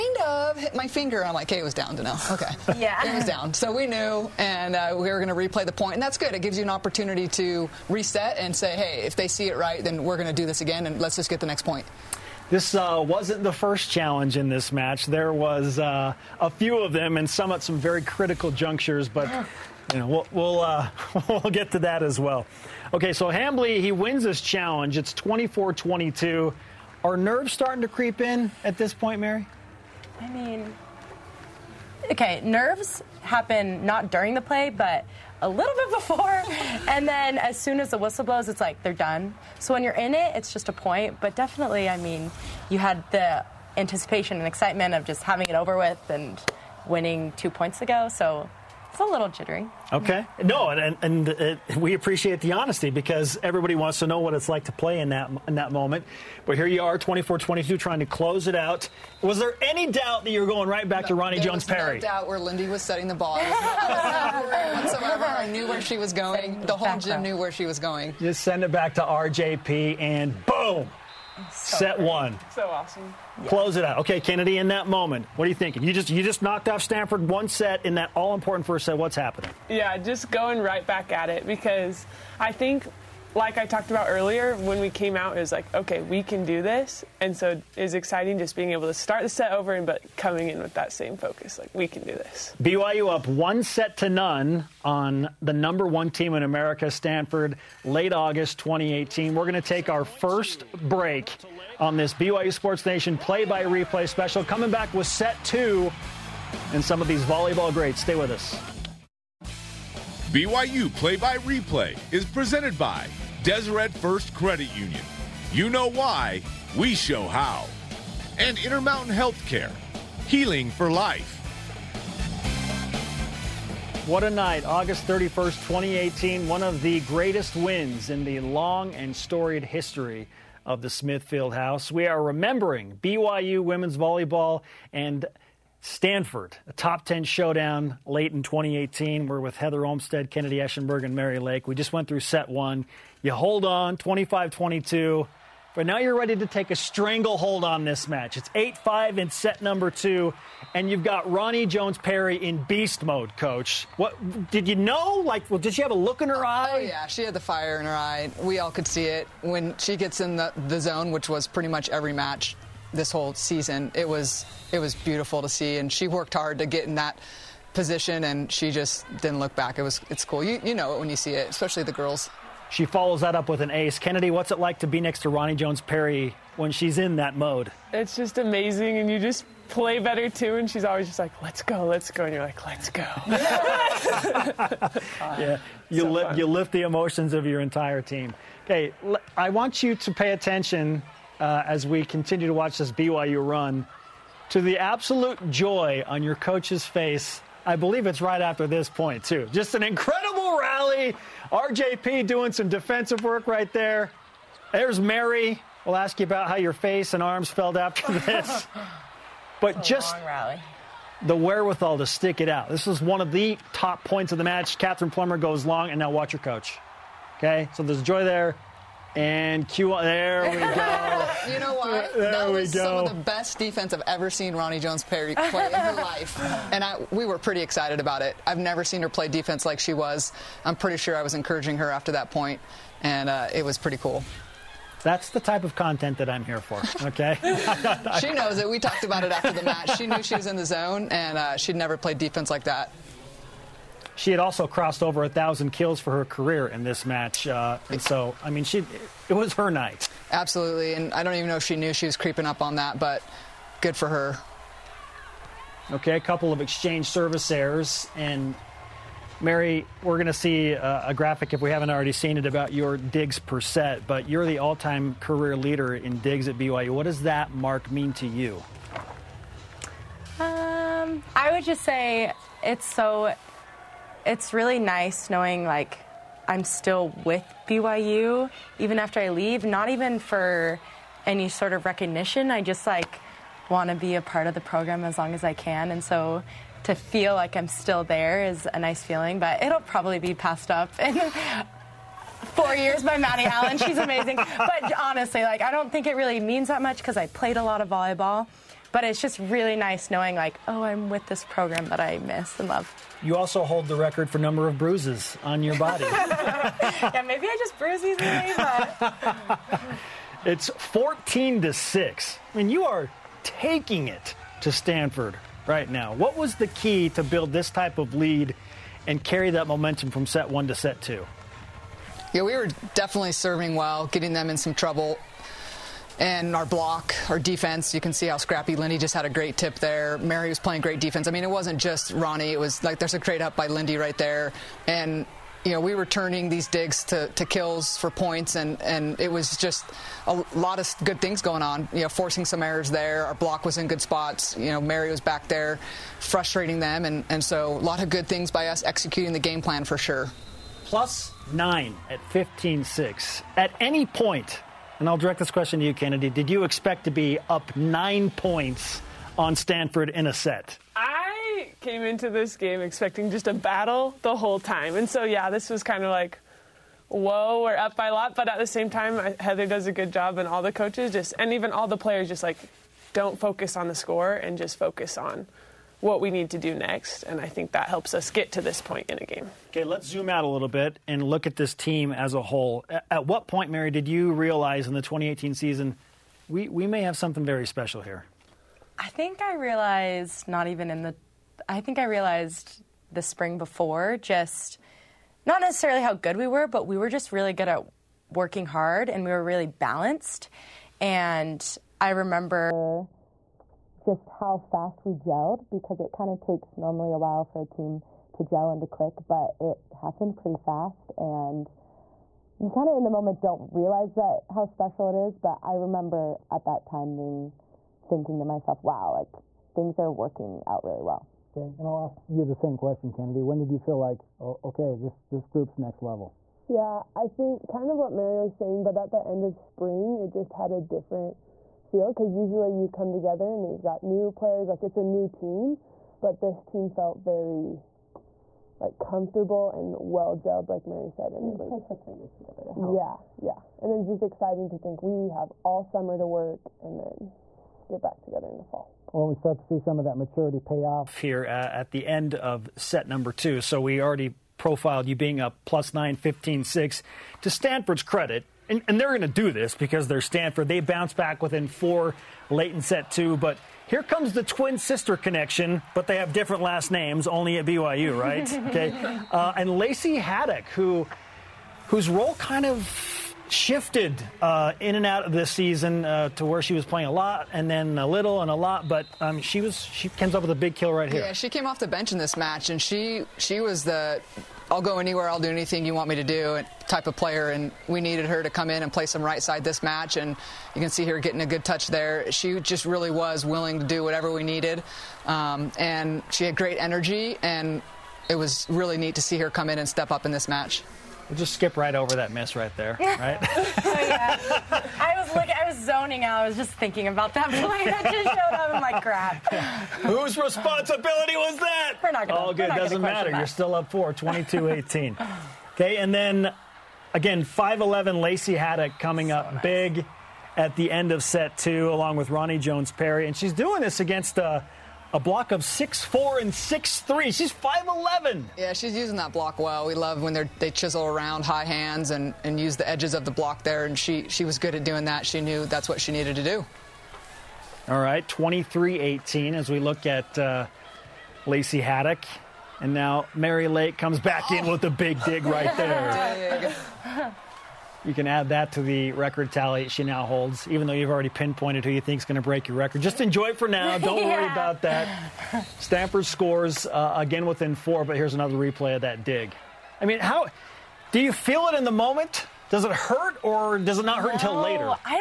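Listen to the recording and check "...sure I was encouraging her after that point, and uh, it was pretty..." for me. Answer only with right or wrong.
right.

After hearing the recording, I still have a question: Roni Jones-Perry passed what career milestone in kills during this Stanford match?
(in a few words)
1000 kills.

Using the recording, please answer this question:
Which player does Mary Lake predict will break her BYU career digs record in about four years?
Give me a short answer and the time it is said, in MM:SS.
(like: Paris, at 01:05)
Maddie Allen, at 04:53.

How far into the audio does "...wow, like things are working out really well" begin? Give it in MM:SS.
06:58.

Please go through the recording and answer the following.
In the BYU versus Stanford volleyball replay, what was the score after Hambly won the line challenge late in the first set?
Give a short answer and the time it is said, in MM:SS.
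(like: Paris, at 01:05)
24-22, at 00:24.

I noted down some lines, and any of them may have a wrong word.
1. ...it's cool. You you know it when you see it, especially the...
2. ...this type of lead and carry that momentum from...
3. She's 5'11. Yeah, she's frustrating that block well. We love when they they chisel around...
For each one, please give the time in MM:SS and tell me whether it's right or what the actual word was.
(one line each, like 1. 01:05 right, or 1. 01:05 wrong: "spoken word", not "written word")
1. 02:50 right
2. 05:17 right
3. 08:47 wrong: "using", not "frustrating".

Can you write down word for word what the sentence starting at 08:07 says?
And we needed her to come in and play some right side this match.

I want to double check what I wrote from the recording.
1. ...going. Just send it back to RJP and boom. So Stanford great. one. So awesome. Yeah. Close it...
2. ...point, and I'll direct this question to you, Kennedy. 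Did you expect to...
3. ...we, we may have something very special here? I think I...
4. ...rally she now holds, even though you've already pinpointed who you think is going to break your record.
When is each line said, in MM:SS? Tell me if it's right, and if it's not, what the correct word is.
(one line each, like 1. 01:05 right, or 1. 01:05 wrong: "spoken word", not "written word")
1. 01:07 wrong: "Set", not "Stanford"
2. 05:54 right
3. 06:26 right
4. 09:09 wrong: "tally", not "rally".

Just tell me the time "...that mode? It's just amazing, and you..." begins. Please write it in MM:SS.
02:57.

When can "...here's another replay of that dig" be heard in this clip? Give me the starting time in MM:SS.
09:18.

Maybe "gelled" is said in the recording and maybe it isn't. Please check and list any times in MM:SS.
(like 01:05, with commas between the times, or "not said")
06:45, 07:20.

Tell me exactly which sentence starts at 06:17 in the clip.
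And I think that helps us get to this point in a game.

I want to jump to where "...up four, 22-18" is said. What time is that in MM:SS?
08:33.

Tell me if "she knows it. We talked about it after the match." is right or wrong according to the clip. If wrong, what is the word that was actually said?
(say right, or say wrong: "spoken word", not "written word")
right.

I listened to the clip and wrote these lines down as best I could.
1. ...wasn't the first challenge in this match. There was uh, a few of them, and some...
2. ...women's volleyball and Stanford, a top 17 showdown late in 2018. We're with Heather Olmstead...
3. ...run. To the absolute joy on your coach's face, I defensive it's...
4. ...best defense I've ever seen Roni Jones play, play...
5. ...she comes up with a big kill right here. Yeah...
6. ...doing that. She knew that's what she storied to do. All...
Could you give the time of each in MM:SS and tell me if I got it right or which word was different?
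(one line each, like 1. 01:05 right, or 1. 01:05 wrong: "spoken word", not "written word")
1. 00:13 right
2. 02:13 wrong: "10", not "17"
3. 03:13 wrong: "believe", not "defensive"
4. 03:43 right
5. 07:59 right
6. 08:54 wrong: "needed", not "storied".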